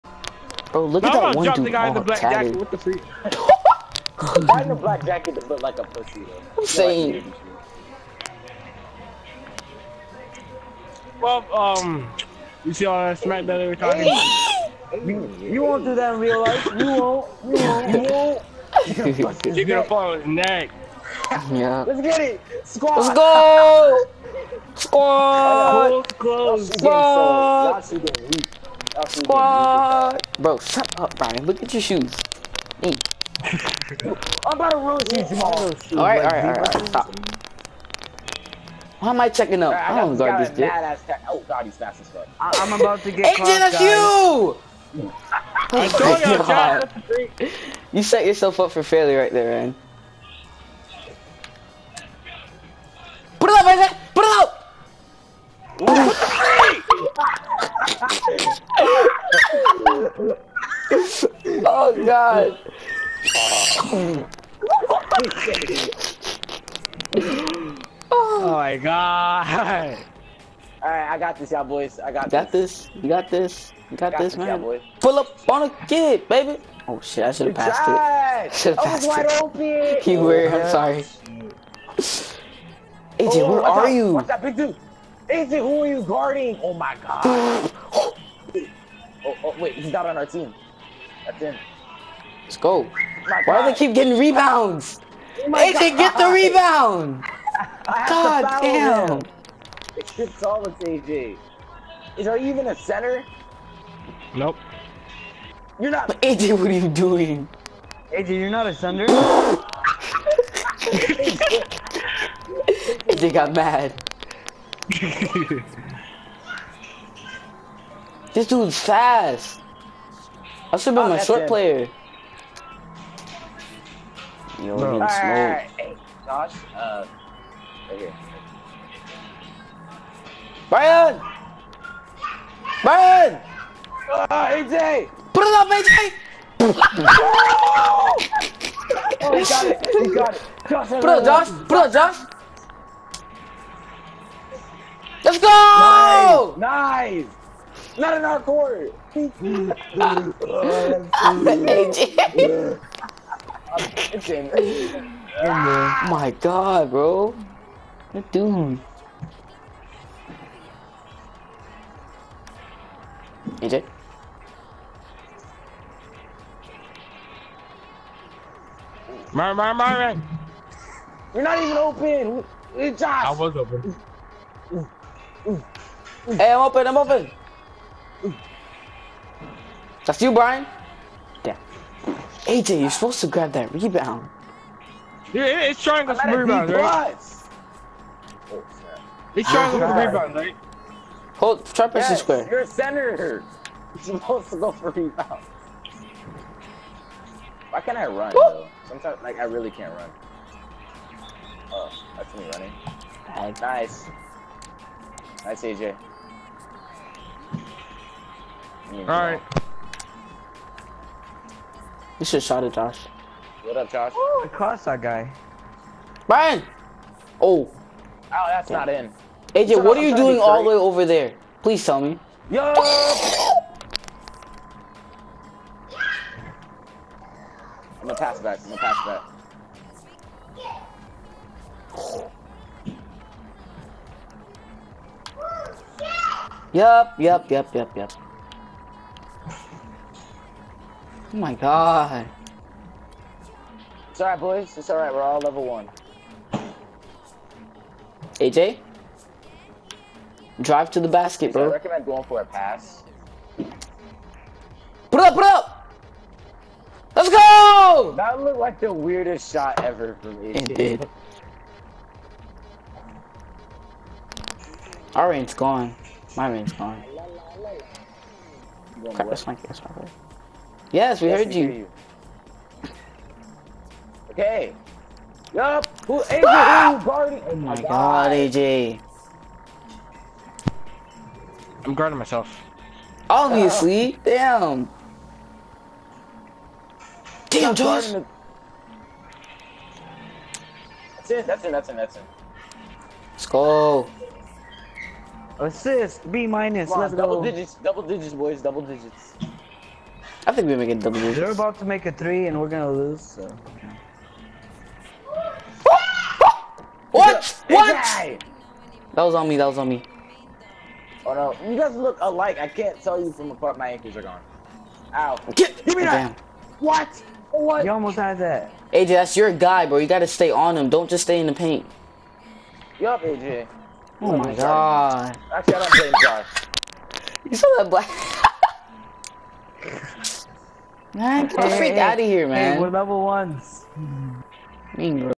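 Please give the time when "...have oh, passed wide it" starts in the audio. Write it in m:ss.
1:18.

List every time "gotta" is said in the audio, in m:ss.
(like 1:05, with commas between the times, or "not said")
5:20.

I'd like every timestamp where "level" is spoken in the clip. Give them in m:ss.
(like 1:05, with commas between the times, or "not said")
4:05, 5:32.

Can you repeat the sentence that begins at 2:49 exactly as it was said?
Mar, mar, mar, You're not even open!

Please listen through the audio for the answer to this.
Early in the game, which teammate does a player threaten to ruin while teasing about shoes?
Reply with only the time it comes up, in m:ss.
0:35.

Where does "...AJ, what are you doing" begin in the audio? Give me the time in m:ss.
1:46.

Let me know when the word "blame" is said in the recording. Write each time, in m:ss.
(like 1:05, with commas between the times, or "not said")
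5:25.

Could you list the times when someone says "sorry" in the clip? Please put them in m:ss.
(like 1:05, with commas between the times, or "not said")
1:20.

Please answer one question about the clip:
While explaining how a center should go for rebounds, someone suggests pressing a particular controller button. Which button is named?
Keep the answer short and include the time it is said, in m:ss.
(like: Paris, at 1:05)
Square, at 3:12.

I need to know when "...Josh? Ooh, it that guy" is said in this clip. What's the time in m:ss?
3:33.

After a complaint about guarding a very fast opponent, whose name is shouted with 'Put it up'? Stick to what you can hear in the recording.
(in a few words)
Isaac.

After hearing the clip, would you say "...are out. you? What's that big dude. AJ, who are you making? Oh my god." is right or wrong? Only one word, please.
wrong.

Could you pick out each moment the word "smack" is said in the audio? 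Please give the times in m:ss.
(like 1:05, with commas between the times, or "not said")
0:13.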